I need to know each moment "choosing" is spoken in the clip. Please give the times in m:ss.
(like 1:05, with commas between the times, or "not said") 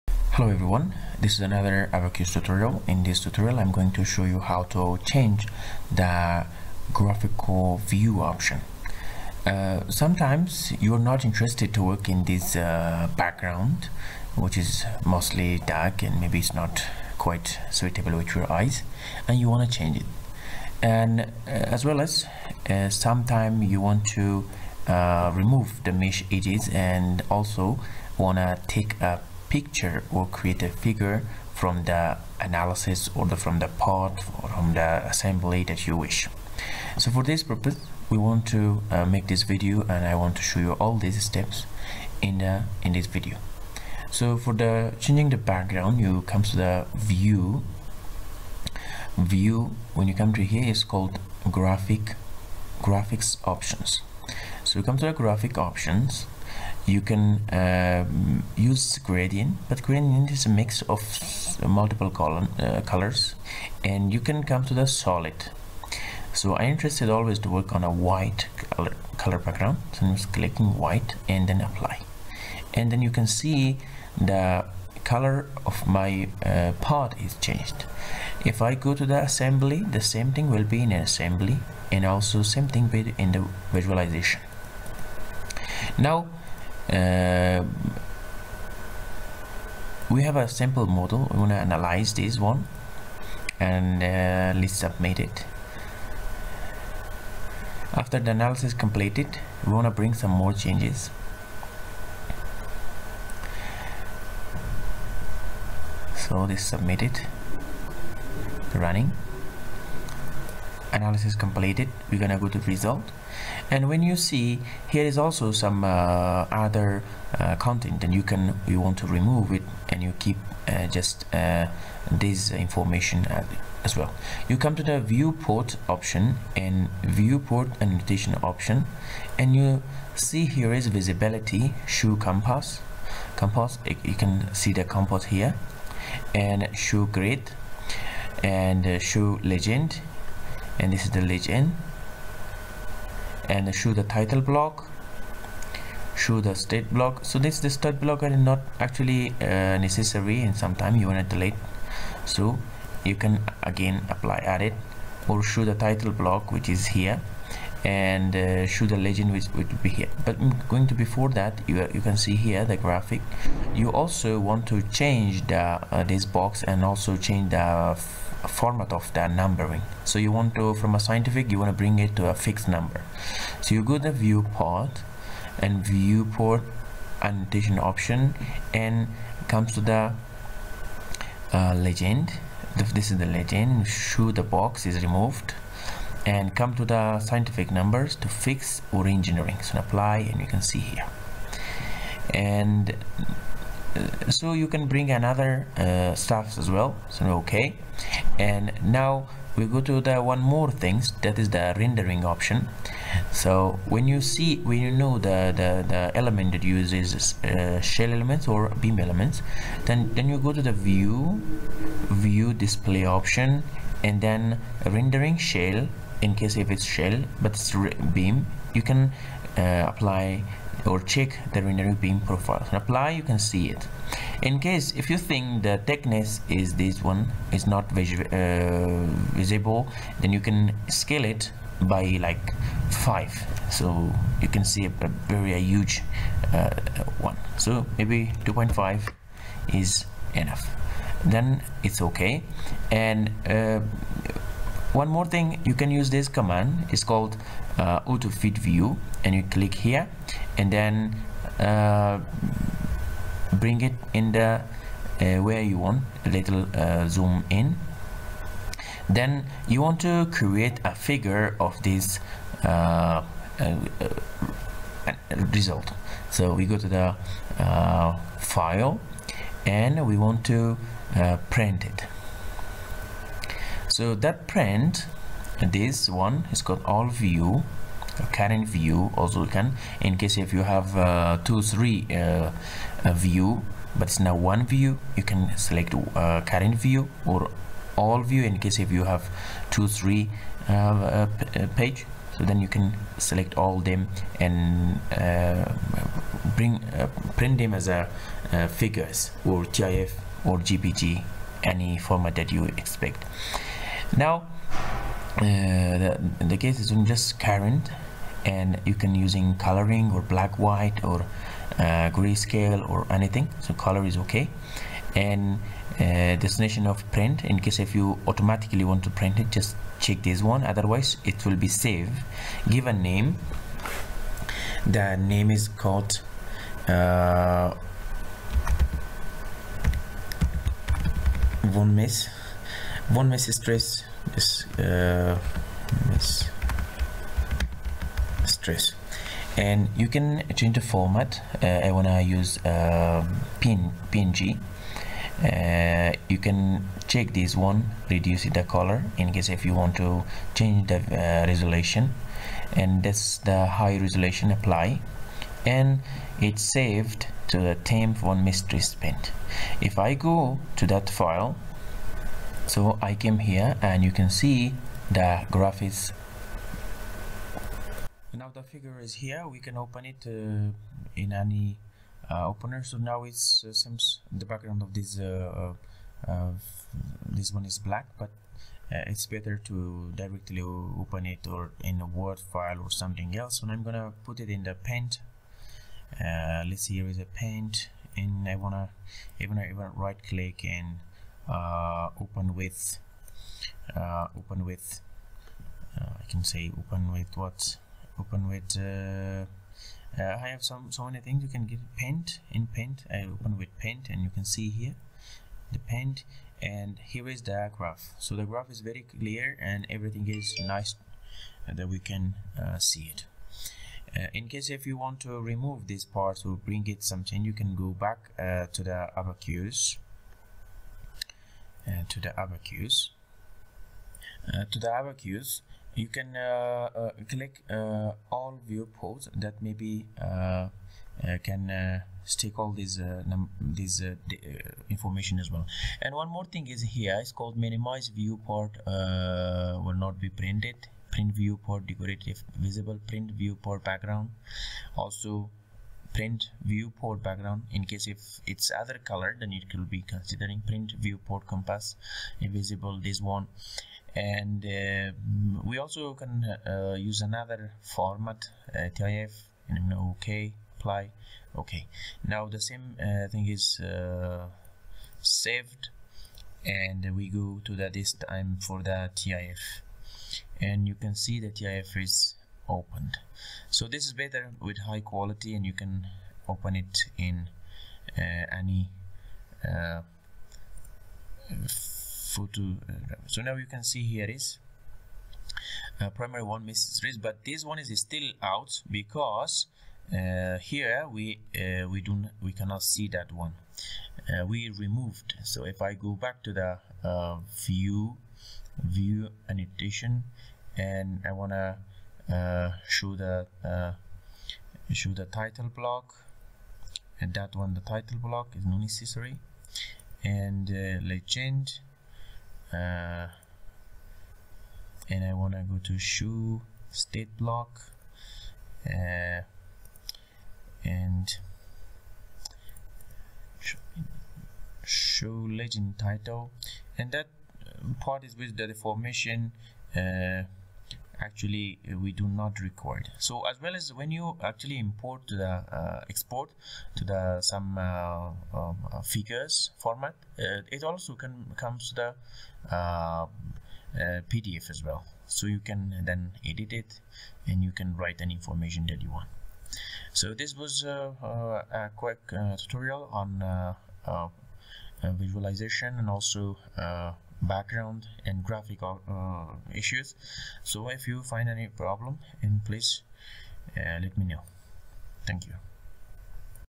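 not said.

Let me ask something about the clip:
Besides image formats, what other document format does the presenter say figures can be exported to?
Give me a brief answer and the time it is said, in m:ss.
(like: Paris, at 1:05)
PDF, at 9:04.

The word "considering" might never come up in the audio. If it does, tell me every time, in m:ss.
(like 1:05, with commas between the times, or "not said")
7:30.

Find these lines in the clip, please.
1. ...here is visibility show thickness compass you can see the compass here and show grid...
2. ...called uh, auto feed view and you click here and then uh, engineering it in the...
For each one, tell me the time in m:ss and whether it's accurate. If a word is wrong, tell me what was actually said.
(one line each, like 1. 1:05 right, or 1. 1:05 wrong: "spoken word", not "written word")
1. 2:10 wrong: "compass", not "thickness"
2. 4:07 wrong: "bring", not "engineering".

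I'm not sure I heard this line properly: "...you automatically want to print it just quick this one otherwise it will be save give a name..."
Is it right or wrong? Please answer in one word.
wrong.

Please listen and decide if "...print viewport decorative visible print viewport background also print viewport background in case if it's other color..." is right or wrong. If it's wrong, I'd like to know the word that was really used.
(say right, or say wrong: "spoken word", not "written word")
right.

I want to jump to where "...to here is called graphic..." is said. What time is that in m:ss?
0:50.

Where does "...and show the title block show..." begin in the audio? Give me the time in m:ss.
2:23.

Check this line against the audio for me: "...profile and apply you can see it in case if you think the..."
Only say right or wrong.
right.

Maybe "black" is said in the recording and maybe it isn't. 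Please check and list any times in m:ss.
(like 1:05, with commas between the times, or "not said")
5:10, 6:17.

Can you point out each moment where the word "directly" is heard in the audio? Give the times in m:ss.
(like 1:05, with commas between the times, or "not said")
6:20.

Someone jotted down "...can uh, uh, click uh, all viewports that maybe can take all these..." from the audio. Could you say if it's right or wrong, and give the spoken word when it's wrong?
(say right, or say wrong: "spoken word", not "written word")
right.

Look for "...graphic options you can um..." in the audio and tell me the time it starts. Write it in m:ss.
0:55.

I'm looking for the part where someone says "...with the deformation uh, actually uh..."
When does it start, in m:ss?
8:48.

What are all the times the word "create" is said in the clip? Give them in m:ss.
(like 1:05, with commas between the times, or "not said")
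0:30, 4:20.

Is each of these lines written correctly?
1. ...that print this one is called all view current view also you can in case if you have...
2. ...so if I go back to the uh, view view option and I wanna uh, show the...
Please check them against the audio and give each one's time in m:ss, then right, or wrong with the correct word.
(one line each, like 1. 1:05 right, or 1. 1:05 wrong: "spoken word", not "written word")
1. 4:34 right
2. 8:15 wrong: "annotation", not "option".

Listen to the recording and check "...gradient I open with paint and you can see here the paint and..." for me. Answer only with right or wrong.
wrong.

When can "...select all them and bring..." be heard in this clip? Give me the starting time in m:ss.
4:53.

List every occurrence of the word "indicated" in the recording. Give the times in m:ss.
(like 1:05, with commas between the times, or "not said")
not said.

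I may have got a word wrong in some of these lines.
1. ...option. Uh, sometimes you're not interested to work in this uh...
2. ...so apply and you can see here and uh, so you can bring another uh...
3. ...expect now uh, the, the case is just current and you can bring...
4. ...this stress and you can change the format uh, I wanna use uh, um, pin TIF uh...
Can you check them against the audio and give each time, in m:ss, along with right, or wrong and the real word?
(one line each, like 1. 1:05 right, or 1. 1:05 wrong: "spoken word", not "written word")
1. 0:08 right
2. 3:09 right
3. 5:02 wrong: "using", not "bring"
4. 5:36 wrong: "PNG", not "TIF".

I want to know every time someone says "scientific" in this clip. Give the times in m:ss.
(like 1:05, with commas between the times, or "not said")
2:50, 3:07.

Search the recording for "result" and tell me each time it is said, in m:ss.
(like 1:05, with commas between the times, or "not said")
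1:52, 4:25.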